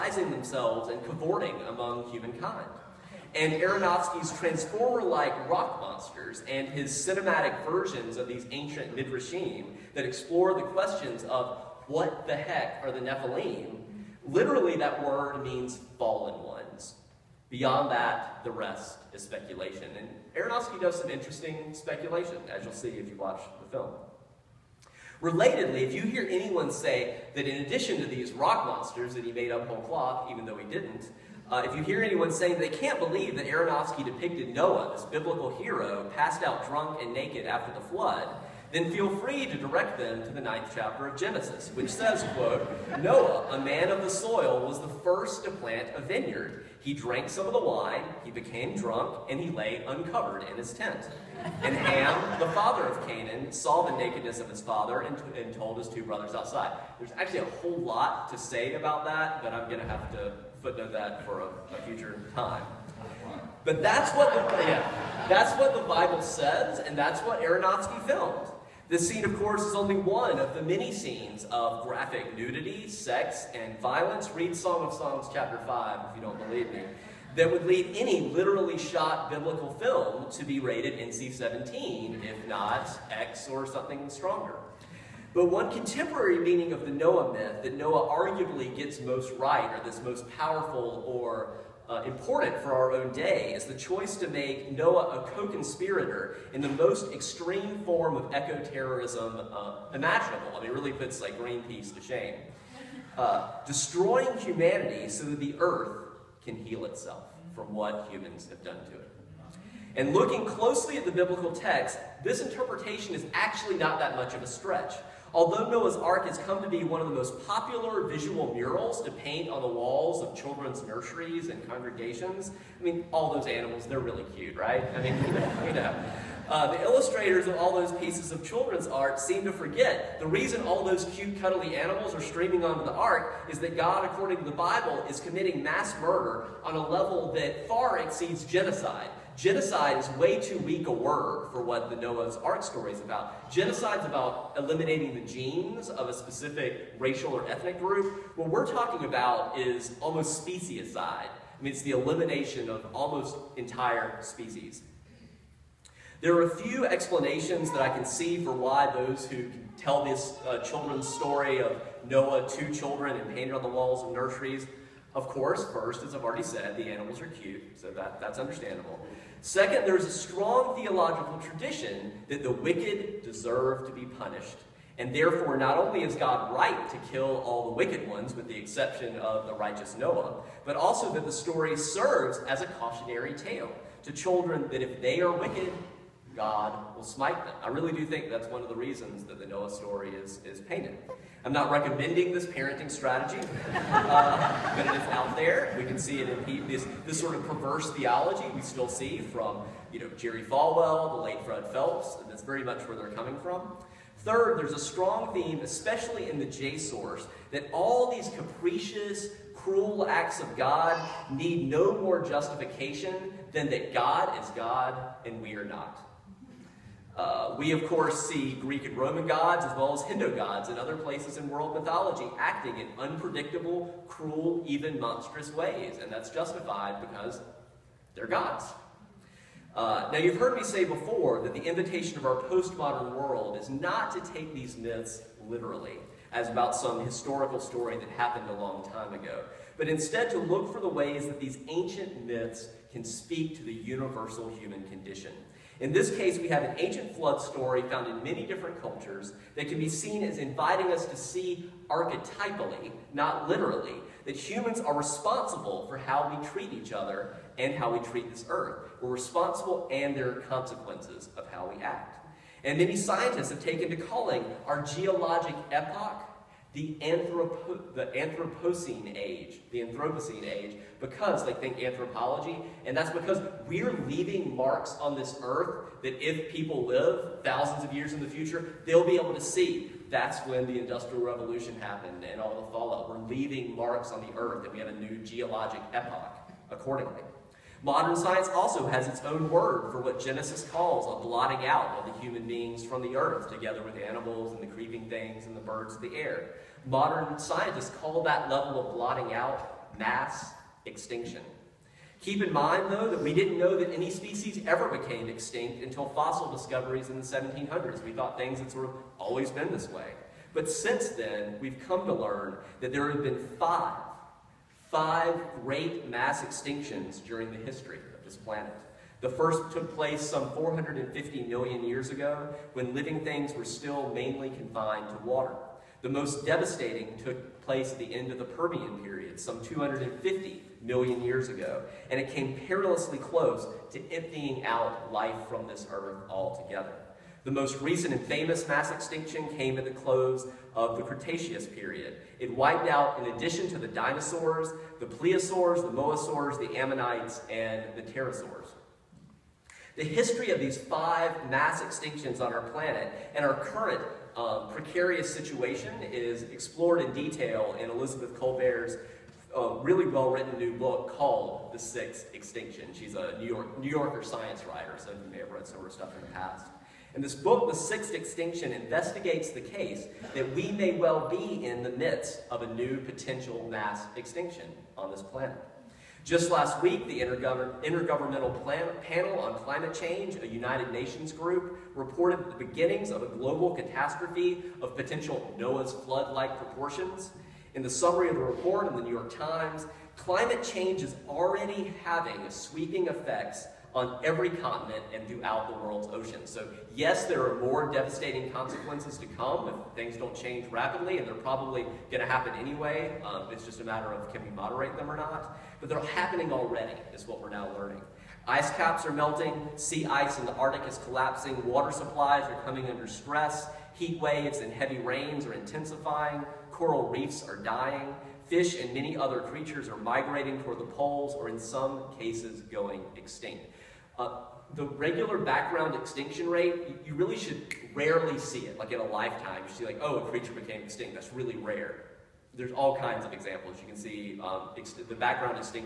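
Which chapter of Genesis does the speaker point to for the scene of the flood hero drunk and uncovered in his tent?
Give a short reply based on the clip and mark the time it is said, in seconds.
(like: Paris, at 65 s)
ninth chapter, at 40 s.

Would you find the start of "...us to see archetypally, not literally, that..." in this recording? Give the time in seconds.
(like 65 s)
250 s.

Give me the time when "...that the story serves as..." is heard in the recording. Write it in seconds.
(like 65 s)
181 s.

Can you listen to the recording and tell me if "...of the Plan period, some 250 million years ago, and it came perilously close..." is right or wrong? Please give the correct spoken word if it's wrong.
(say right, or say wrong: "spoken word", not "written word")
wrong: "Permian", not "Plan".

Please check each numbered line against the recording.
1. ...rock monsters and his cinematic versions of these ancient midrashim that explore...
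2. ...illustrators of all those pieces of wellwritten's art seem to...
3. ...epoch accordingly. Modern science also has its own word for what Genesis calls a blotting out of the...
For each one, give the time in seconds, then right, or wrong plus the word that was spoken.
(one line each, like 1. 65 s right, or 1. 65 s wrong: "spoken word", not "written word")
1. 5 s right
2. 126 s wrong: "children", not "wellwritten"
3. 285 s right.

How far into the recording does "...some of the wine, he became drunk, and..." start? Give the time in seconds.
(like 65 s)
47 s.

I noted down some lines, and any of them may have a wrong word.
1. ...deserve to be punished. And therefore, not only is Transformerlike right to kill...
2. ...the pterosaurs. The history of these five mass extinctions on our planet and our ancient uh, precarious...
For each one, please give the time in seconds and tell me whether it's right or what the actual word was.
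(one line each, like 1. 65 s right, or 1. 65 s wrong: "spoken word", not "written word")
1. 173 s wrong: "God", not "Transformerlike"
2. 347 s wrong: "current", not "ancient".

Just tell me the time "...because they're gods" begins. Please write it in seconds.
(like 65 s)
227 s.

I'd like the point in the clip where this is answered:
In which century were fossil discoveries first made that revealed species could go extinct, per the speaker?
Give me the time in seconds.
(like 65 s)
307 s.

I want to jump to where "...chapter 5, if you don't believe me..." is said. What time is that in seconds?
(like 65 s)
75 s.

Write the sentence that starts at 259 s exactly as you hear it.
We're responsible and there are consequences of how we act.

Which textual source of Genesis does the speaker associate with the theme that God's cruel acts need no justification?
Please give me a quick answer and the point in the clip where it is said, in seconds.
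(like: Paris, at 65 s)
J source, at 206 s.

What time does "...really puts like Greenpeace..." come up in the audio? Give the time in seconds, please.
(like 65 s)
100 s.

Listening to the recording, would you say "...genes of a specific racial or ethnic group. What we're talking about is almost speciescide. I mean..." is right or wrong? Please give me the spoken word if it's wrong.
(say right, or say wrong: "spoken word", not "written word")
right.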